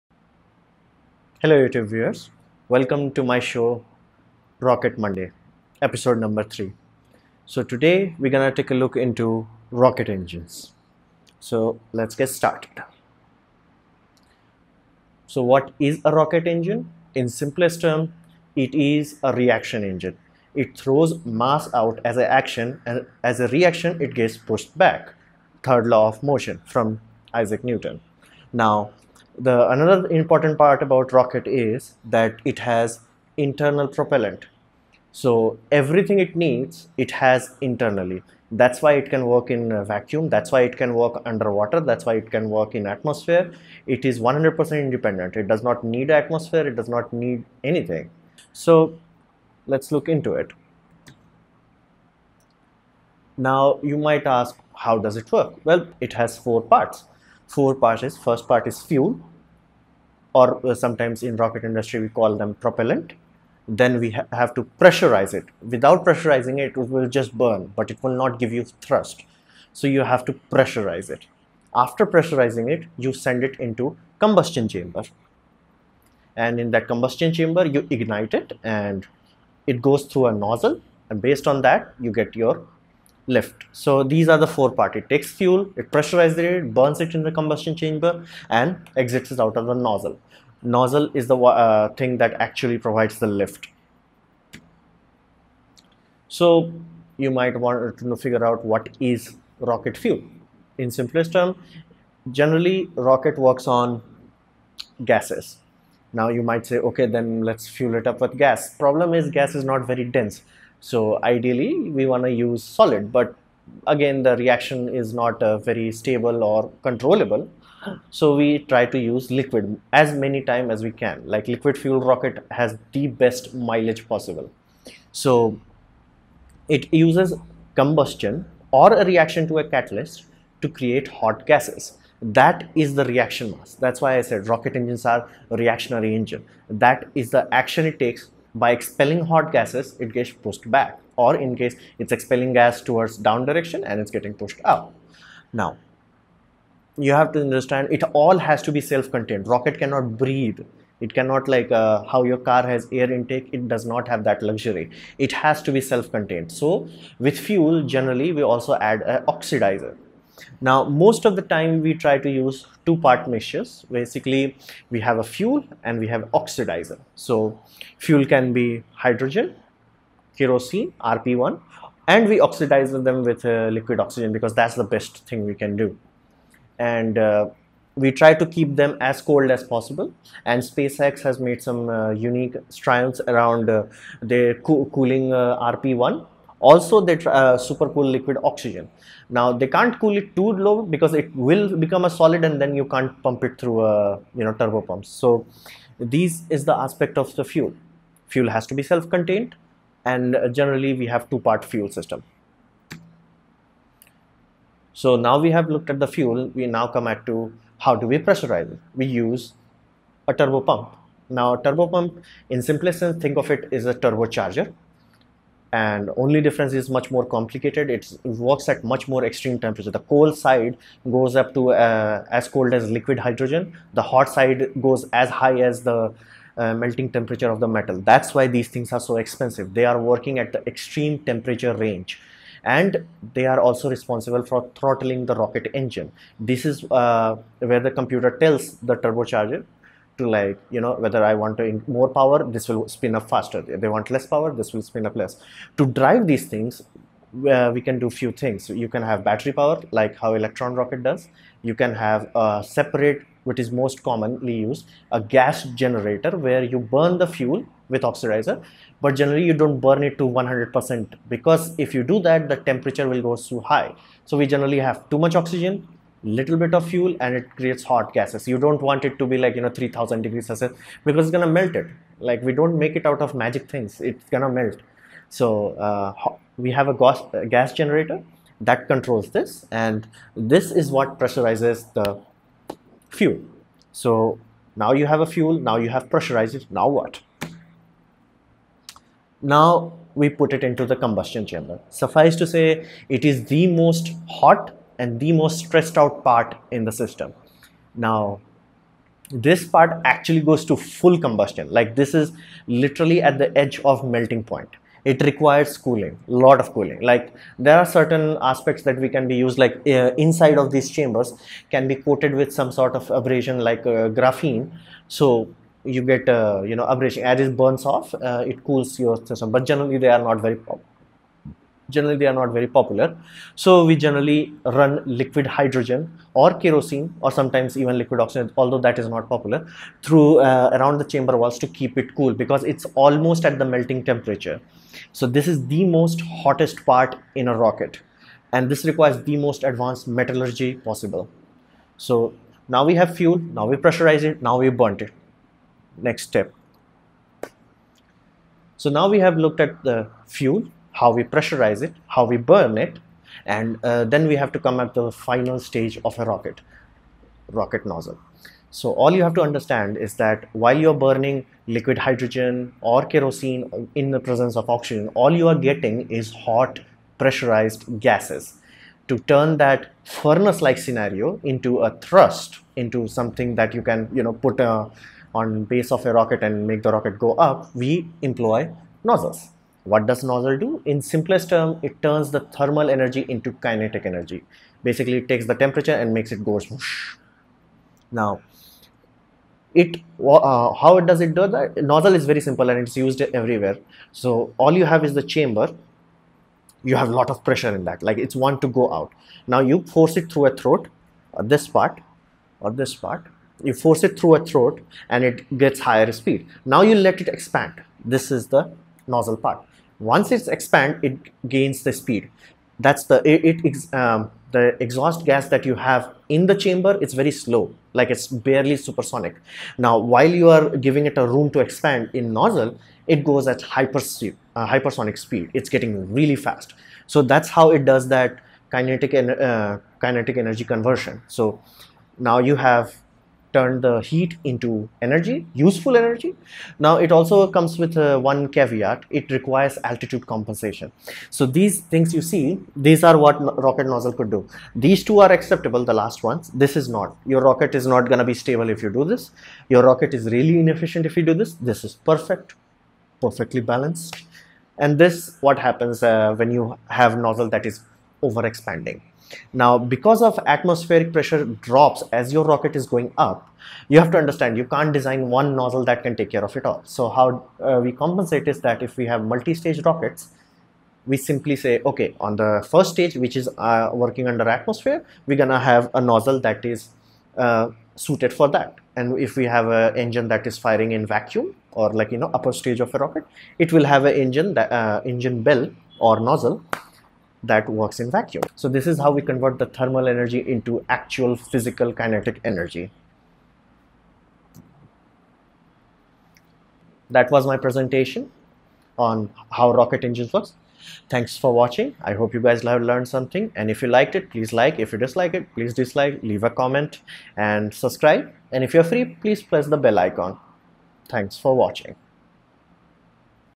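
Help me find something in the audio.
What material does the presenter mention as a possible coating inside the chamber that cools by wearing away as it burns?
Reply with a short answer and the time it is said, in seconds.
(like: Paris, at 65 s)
graphene, at 314 s.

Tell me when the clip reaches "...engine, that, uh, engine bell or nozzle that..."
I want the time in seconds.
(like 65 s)
484 s.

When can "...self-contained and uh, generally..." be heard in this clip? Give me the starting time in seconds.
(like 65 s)
198 s.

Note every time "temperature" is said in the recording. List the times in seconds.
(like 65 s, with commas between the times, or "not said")
219 s, 227 s, 231 s, 262 s, 334 s, 385 s.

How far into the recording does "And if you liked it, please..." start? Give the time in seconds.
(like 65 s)
503 s.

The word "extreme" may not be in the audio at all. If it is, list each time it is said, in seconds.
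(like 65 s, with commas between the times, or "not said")
219 s, 230 s.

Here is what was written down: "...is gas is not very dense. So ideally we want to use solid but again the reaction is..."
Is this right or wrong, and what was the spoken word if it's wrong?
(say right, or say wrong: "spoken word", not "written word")
right.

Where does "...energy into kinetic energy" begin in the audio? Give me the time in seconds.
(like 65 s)
382 s.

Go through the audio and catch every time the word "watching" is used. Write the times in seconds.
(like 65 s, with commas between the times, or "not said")
501 s, 511 s.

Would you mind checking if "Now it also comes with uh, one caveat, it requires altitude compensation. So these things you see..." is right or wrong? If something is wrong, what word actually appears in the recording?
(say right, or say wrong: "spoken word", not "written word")
right.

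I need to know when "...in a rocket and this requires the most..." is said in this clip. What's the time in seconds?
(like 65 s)
337 s.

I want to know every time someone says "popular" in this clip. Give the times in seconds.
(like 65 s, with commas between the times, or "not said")
322 s, 329 s.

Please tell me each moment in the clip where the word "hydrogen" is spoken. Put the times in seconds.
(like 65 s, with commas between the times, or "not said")
168 s, 223 s, 325 s, 361 s.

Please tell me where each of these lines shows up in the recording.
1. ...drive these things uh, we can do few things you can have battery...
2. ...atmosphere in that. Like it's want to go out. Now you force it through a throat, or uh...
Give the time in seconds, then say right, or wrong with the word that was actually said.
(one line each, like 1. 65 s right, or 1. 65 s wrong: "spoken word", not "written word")
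1. 246 s right
2. 397 s wrong: "pressure", not "atmosphere".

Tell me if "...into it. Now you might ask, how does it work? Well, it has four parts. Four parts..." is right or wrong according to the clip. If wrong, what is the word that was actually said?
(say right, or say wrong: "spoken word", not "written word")
right.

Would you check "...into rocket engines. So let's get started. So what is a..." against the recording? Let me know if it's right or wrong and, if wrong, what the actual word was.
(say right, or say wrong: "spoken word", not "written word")
right.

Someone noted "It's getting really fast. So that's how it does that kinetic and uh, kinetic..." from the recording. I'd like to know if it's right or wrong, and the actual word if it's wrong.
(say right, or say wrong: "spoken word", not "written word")
right.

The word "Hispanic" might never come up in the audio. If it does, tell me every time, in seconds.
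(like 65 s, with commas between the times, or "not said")
not said.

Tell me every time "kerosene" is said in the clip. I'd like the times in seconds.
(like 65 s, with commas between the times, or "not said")
170 s, 326 s, 363 s.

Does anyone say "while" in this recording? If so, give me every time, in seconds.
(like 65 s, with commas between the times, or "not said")
360 s, 419 s.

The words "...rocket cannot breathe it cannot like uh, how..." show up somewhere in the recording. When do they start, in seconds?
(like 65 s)
149 s.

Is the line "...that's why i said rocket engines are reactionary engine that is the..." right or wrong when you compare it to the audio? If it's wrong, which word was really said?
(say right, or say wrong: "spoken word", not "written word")
right.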